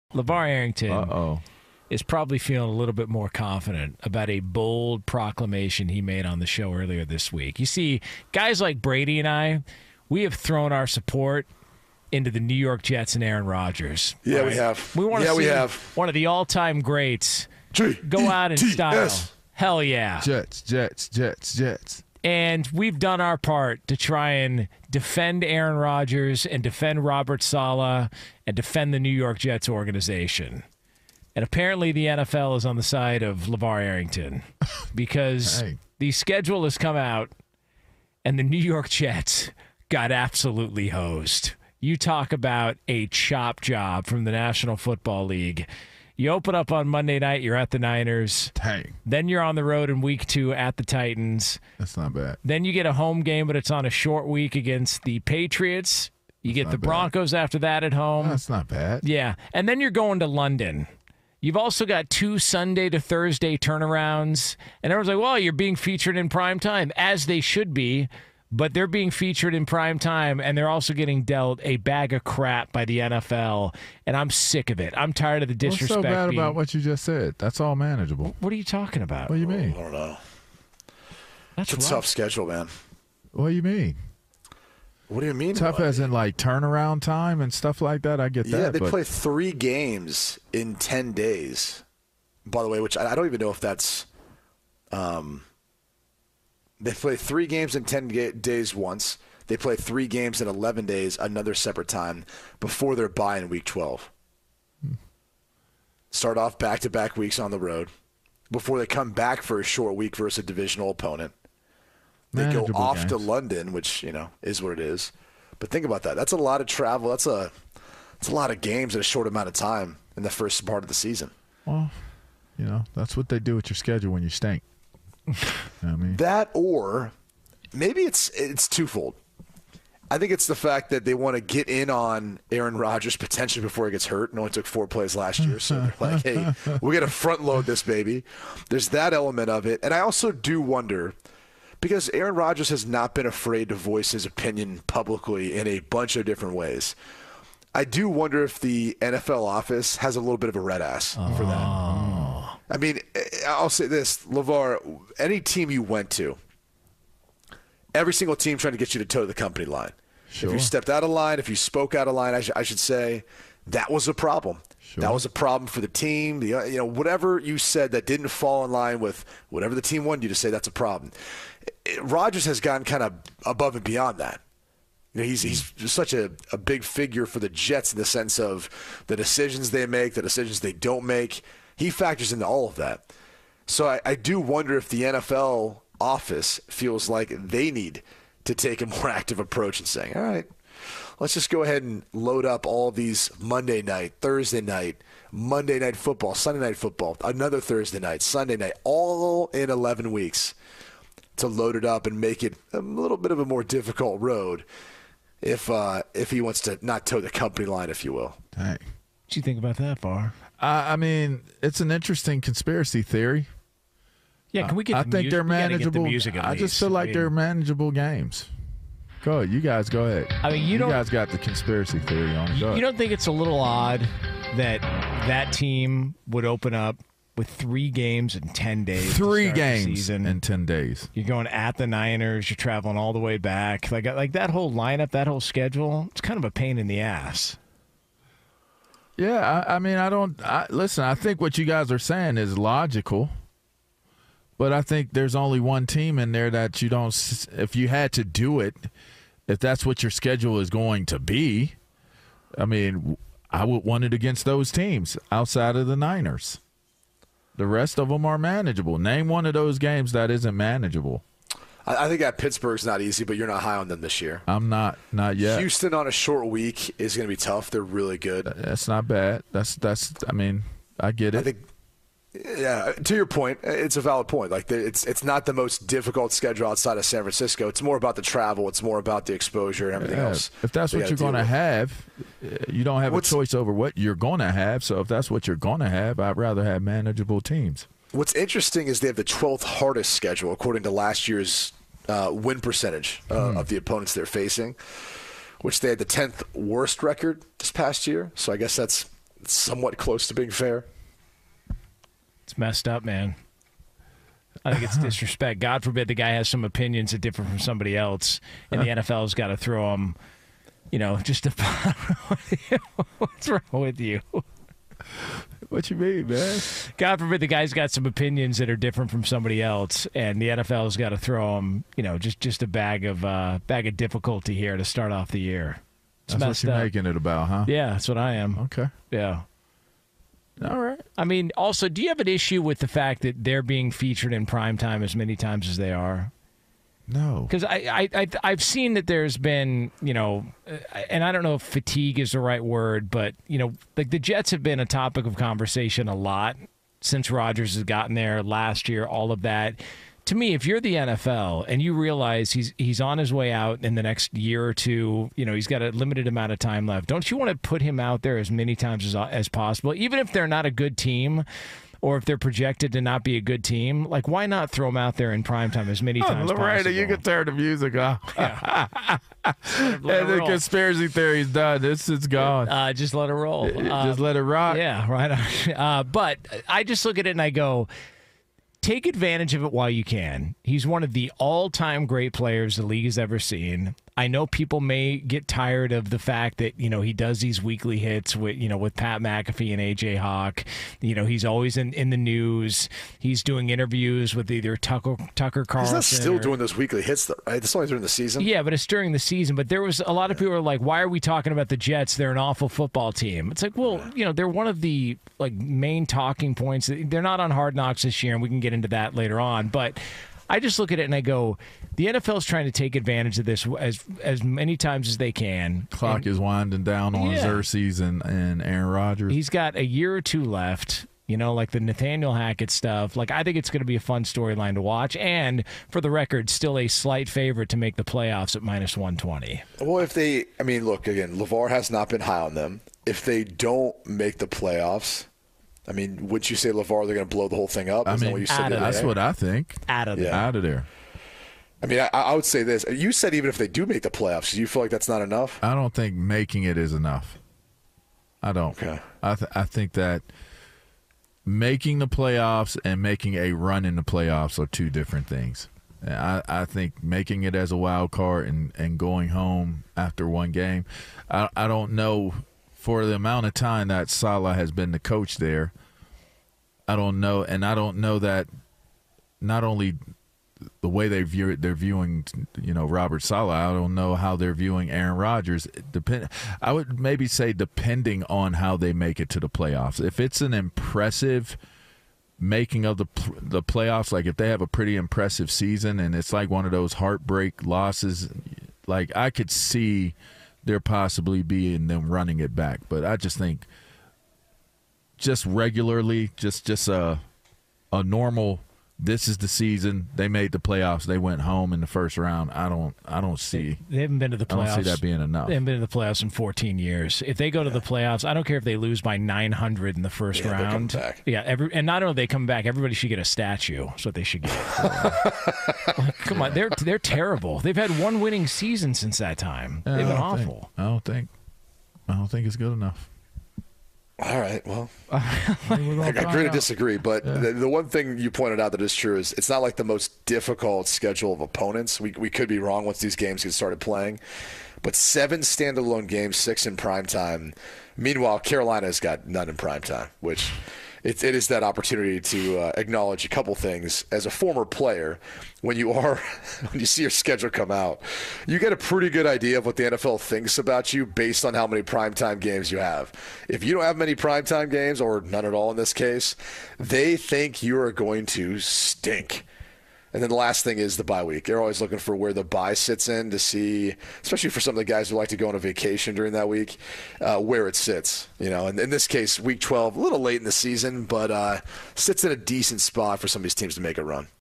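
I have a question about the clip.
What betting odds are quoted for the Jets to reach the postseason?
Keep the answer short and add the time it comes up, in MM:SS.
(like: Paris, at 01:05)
-120, at 07:08.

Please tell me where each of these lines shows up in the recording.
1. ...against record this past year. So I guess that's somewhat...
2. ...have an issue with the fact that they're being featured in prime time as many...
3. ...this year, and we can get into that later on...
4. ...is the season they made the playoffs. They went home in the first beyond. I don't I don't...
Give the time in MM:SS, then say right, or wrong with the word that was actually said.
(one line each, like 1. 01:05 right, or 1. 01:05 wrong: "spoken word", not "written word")
1. 04:56 wrong: "worst", not "against"
2. 05:32 right
3. 06:48 right
4. 08:19 wrong: "round", not "beyond".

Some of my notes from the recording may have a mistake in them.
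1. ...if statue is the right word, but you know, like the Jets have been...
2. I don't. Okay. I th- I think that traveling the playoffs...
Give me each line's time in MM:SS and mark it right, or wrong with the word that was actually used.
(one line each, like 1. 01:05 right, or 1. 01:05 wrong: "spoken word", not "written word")
1. 05:41 wrong: "fatigue", not "statue"
2. 07:28 wrong: "making", not "traveling".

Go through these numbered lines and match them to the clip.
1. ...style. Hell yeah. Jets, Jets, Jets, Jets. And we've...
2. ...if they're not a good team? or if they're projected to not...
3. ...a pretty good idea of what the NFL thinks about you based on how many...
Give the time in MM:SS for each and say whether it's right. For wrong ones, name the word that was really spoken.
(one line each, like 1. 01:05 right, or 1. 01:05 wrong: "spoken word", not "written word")
1. 00:18 right
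2. 06:00 right
3. 09:08 right.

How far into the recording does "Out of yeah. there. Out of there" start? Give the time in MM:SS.
07:19.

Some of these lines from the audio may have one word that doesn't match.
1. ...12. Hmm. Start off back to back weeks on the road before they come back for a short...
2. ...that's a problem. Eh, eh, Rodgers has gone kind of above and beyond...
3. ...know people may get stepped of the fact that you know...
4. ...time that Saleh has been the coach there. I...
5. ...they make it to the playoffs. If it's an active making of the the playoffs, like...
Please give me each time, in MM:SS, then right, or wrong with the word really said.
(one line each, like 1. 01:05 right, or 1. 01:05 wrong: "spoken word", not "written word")
1. 01:43 right
2. 02:50 right
3. 06:24 wrong: "tired", not "stepped"
4. 07:43 right
5. 07:58 wrong: "impressive", not "active".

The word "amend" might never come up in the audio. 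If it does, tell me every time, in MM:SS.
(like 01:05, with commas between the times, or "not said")
not said.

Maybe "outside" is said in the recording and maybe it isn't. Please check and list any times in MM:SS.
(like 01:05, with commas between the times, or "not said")
04:15, 04:36.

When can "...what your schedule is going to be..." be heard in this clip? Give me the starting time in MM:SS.
04:09.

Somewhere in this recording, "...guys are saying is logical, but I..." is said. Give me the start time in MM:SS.
04:01.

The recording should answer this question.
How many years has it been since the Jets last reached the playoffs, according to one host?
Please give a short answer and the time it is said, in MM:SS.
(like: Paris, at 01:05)
14, at 08:26.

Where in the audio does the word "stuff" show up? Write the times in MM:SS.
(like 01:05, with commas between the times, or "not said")
01:27, 07:02.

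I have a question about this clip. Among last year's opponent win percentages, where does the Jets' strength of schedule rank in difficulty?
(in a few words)
12th hardest.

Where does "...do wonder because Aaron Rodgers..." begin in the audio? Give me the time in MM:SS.
02:20.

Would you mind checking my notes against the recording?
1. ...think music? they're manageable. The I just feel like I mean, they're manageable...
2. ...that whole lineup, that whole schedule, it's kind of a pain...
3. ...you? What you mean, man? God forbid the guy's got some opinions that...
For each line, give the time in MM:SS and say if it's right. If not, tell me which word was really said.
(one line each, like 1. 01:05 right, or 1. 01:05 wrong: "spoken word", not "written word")
1. 03:35 right
2. 03:54 right
3. 05:14 right.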